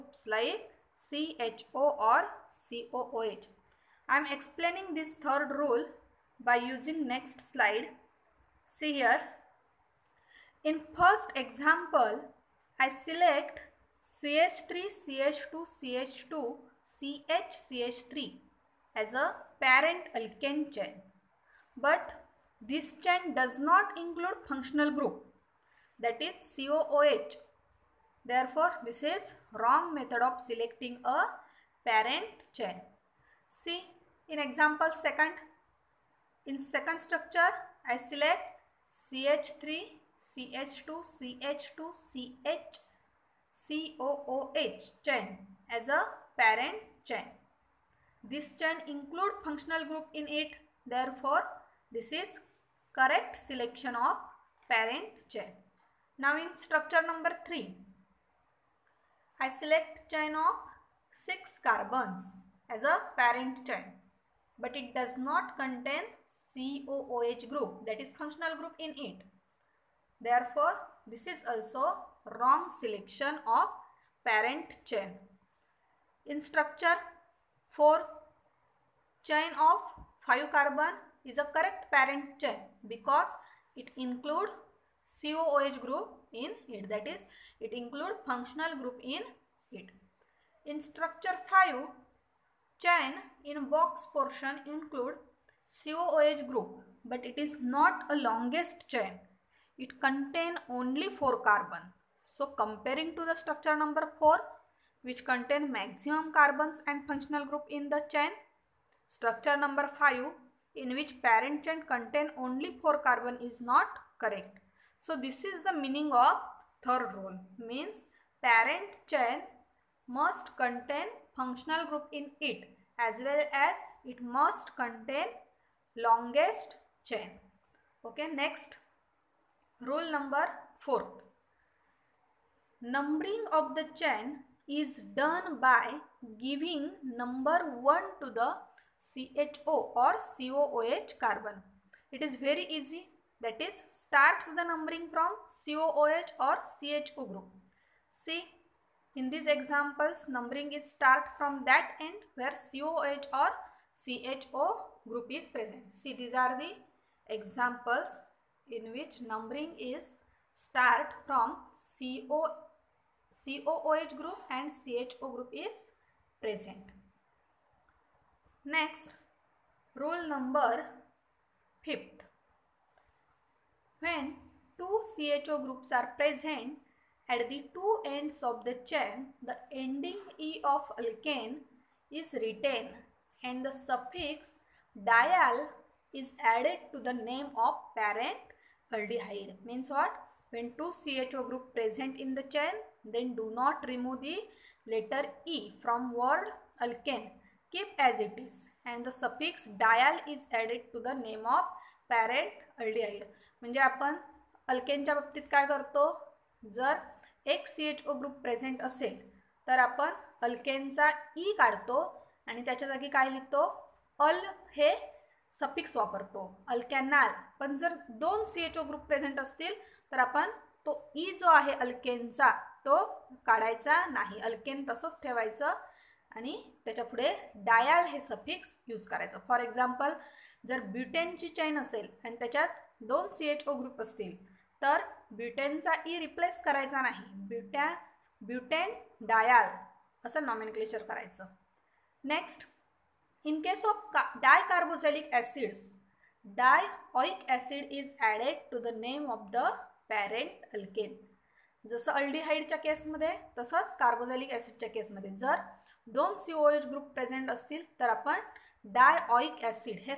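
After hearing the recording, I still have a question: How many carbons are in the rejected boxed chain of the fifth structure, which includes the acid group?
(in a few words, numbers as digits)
4.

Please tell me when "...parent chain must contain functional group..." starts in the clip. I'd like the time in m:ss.
1:58.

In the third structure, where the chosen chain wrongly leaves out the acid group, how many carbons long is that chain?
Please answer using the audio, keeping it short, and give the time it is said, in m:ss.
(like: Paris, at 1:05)
6, at 1:01.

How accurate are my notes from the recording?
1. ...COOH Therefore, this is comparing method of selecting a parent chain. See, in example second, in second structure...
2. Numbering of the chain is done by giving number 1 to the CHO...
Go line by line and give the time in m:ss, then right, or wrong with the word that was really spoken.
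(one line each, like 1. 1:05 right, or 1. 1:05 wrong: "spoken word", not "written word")
1. 0:26 wrong: "wrong", not "comparing"
2. 2:12 right.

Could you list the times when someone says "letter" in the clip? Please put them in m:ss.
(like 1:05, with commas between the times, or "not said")
3:14.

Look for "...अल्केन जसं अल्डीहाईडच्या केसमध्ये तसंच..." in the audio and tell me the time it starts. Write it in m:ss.
4:10.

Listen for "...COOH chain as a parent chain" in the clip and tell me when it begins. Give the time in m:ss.
0:43.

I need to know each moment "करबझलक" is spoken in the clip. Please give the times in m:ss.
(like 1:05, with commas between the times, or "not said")
4:04, 4:13.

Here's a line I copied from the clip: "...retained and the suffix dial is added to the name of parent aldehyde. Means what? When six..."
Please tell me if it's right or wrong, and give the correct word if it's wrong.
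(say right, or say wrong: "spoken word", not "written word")
wrong: "two", not "six".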